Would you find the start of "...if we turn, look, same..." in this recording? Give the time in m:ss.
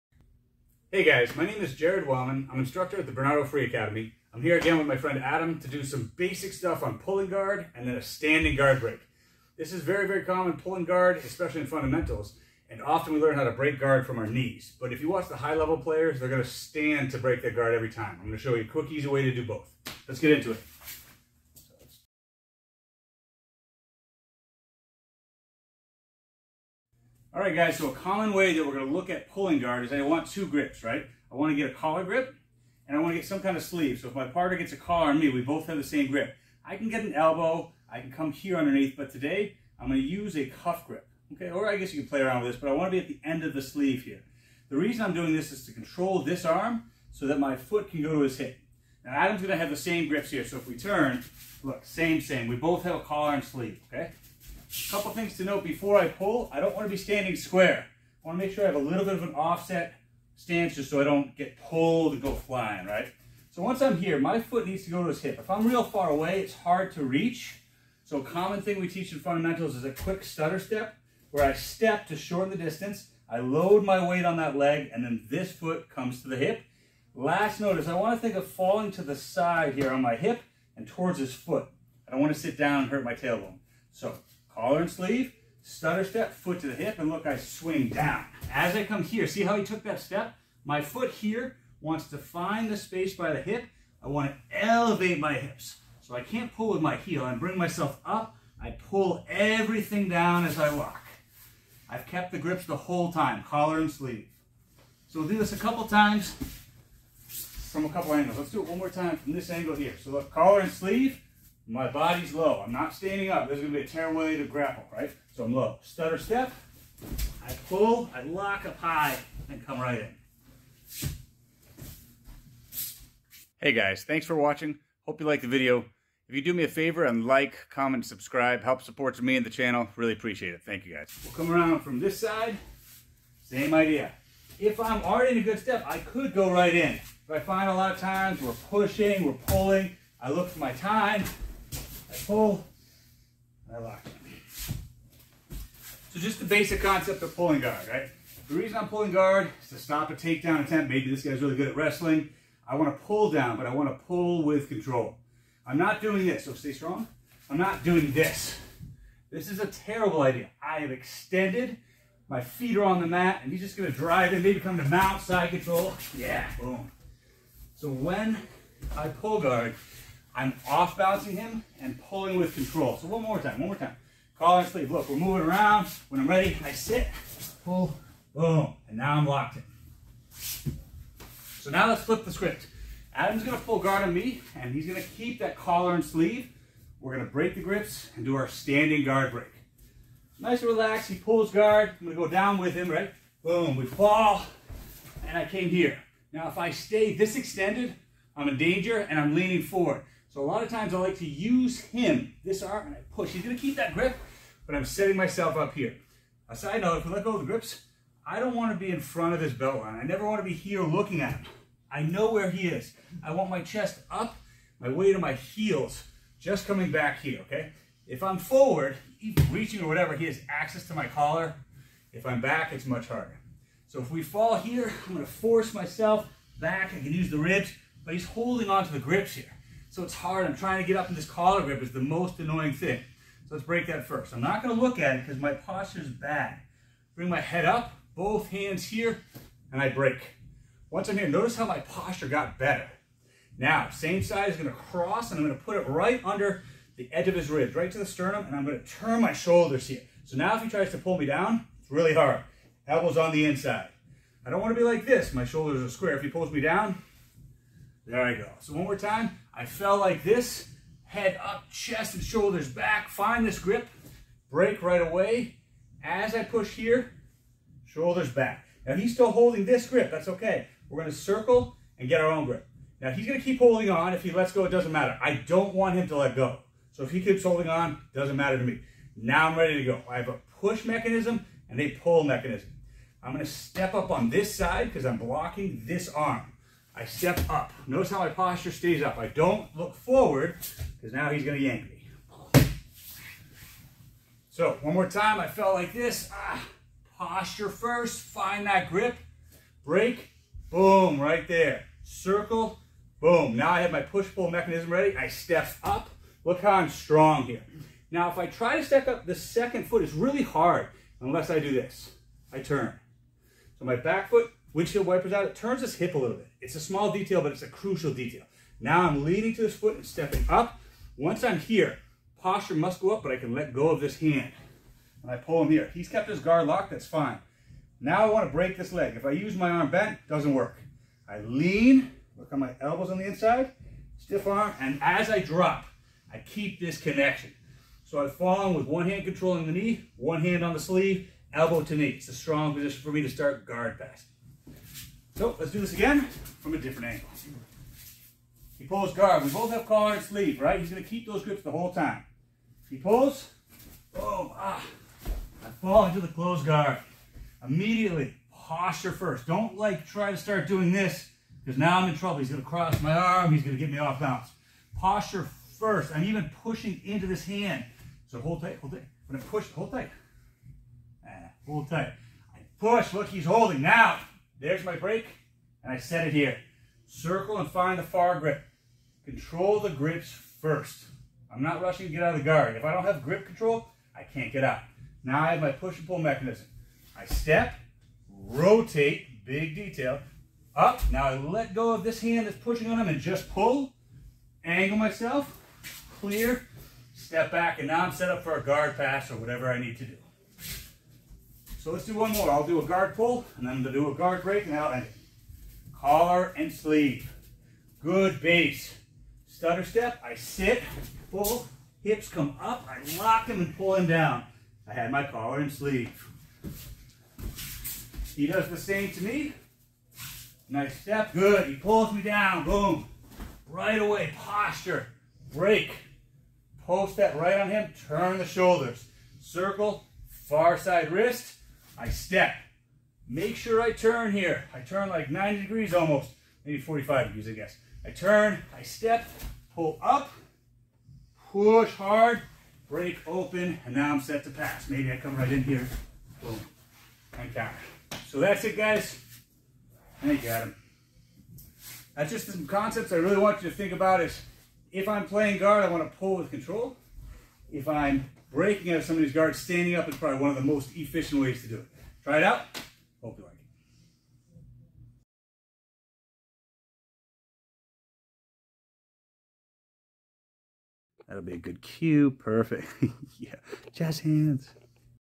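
0:50.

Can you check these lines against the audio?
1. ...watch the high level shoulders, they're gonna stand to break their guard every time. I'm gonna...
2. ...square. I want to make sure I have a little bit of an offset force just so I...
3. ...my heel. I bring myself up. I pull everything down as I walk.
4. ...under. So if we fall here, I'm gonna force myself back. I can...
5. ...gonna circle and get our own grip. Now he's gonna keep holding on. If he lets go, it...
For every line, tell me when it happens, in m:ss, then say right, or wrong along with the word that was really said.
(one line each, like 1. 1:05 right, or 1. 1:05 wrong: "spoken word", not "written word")
1. 0:15 wrong: "players", not "shoulders"
2. 0:57 wrong: "stance", not "force"
3. 1:36 right
4. 3:43 wrong: "harder", not "under"
5. 4:30 right.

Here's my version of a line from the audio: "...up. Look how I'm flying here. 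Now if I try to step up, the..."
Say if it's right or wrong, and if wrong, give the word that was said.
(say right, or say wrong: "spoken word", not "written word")
wrong: "strong", not "flying".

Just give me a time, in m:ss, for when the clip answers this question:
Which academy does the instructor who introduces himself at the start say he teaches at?
0:03.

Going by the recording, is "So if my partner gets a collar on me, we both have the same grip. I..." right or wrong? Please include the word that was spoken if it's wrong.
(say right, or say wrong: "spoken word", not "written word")
right.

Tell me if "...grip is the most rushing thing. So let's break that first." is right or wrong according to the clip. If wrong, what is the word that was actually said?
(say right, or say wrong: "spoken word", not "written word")
wrong: "annoying", not "rushing".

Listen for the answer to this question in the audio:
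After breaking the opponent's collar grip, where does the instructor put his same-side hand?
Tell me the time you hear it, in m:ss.
4:08.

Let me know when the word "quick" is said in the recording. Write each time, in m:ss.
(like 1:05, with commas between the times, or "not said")
0:18, 1:09.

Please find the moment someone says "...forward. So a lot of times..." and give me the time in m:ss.
3:19.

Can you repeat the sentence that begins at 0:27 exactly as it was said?
All right, guys, so a common way that we're going to look at pulling guard is I want two grips, right?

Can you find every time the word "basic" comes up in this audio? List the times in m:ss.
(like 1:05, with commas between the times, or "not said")
0:06, 2:26.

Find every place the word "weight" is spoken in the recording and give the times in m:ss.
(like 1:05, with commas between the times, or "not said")
1:14, 3:34.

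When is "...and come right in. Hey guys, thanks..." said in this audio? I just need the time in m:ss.
1:59.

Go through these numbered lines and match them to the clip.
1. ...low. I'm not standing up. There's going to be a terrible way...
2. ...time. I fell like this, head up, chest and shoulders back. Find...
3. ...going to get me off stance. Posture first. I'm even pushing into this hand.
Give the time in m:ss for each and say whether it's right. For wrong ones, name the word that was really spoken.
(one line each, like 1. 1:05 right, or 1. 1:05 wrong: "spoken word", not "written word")
1. 1:52 right
2. 4:18 right
3. 6:03 wrong: "balance", not "stance".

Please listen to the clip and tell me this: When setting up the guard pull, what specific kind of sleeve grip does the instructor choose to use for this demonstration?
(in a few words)
cuff grip.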